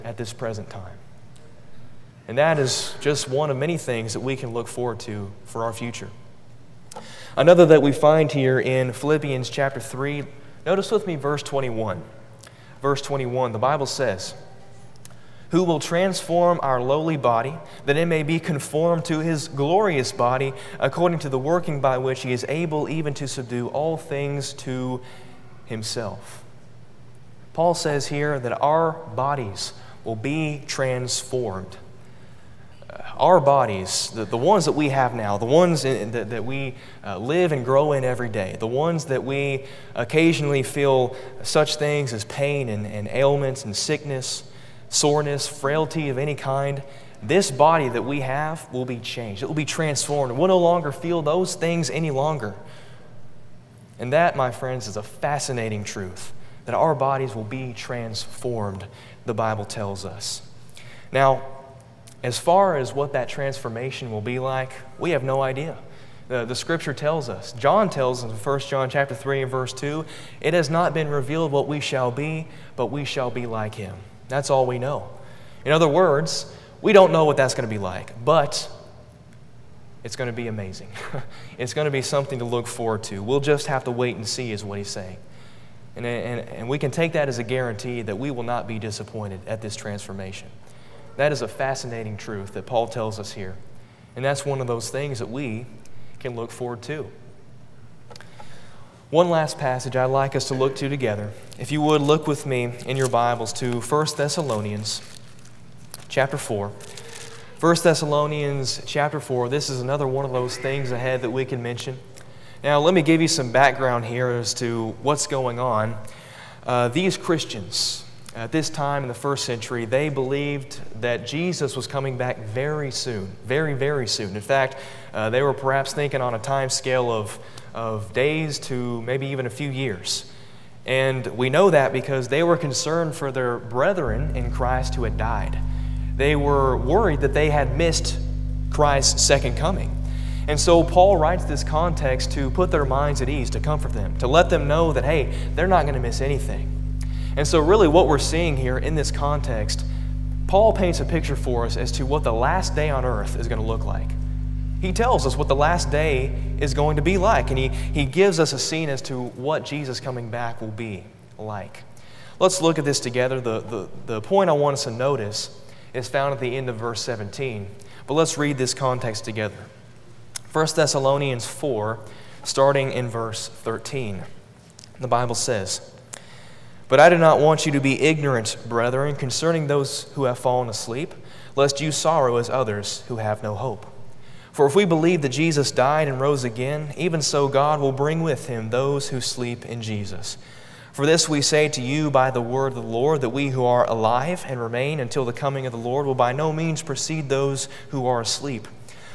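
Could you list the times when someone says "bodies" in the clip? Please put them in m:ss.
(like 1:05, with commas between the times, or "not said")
0:29, 0:33, 0:56.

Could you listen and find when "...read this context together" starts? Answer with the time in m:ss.
2:48.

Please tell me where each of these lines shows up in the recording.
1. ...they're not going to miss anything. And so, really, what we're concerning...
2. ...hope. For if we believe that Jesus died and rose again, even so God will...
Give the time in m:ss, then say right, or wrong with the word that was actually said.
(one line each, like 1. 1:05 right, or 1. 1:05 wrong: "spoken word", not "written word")
1. 2:25 wrong: "seeing", not "concerning"
2. 3:03 right.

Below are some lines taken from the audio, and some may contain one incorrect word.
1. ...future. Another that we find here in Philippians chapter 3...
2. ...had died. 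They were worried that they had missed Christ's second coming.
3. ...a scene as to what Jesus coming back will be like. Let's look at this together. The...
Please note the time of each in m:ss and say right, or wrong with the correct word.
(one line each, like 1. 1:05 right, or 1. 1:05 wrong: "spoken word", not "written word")
1. 0:05 right
2. 2:15 right
3. 2:38 right.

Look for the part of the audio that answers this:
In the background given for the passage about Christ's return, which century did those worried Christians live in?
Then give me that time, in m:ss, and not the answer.
1:59.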